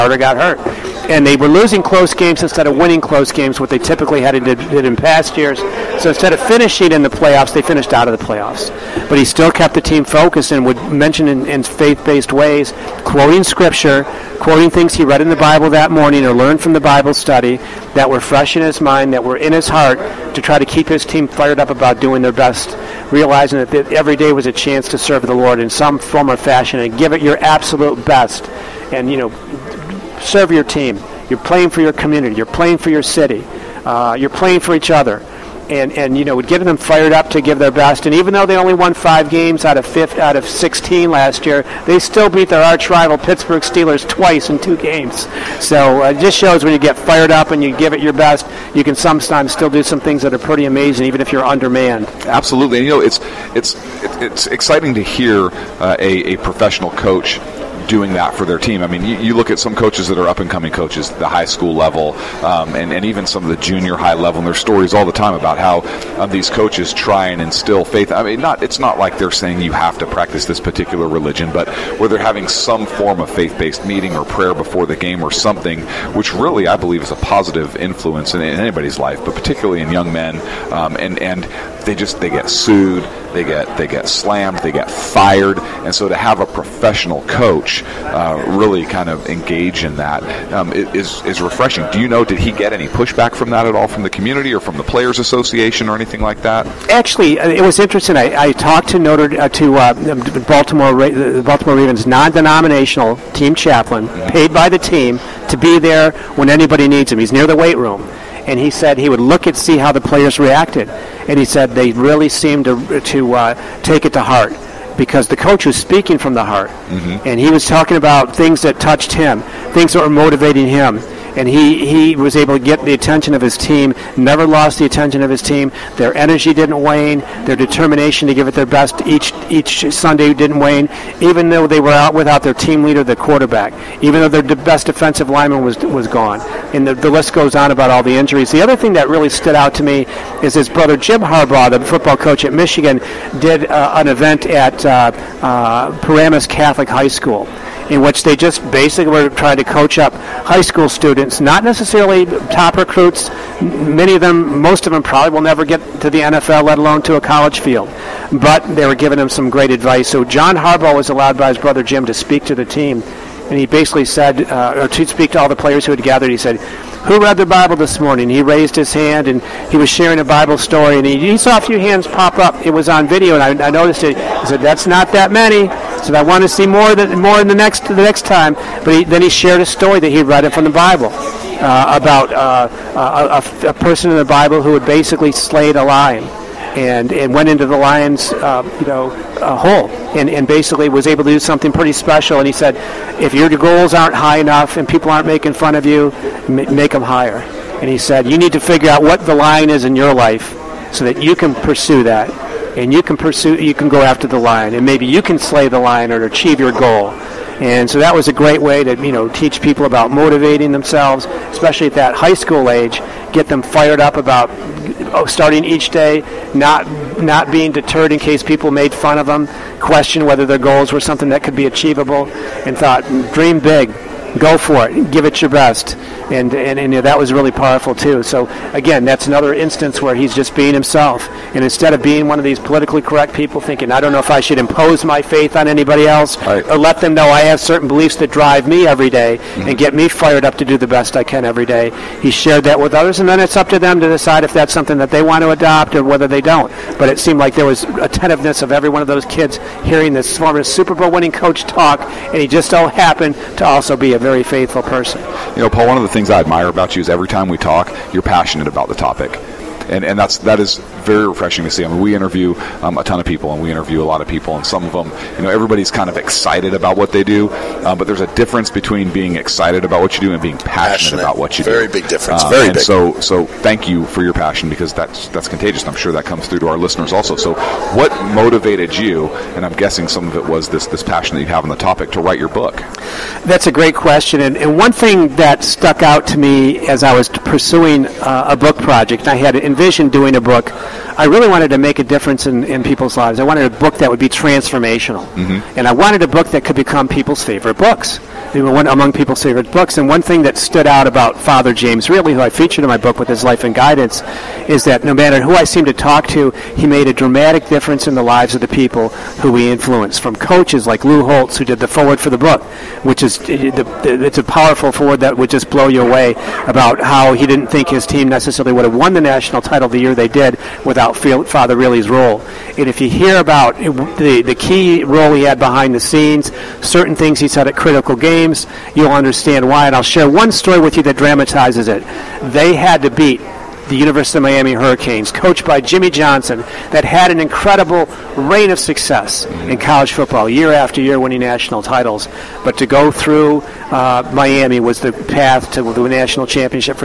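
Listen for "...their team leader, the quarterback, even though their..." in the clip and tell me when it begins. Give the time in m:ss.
2:12.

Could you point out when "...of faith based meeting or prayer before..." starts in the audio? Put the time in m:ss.
1:13.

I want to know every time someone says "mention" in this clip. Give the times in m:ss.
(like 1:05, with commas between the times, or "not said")
0:10.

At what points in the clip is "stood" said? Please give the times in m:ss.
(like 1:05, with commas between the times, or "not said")
2:19, 5:00.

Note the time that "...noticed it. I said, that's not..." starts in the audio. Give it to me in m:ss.
2:53.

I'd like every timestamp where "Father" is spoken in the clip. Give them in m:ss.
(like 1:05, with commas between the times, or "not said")
5:01, 5:21.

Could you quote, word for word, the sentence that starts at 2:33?
Many of them, most of them probably will never get to the NFL, let alone to a college field.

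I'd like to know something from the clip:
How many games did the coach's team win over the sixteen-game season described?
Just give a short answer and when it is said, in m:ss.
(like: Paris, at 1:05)
5, at 0:38.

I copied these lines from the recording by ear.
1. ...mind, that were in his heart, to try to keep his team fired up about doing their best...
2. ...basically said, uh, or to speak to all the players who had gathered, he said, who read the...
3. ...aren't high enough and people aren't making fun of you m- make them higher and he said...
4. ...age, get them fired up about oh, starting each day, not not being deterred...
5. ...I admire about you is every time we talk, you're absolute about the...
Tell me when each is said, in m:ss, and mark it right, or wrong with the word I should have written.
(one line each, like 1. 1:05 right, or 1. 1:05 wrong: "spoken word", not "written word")
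1. 0:18 right
2. 2:43 right
3. 3:13 right
4. 3:32 right
5. 4:16 wrong: "passionate", not "absolute".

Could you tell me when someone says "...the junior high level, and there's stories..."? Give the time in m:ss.
1:03.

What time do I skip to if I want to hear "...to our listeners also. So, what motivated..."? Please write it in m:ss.
4:36.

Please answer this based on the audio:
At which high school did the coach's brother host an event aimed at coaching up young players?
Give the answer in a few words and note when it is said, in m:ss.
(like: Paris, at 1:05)
Paramus Catholic High School, at 2:26.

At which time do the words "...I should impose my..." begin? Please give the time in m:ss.
3:54.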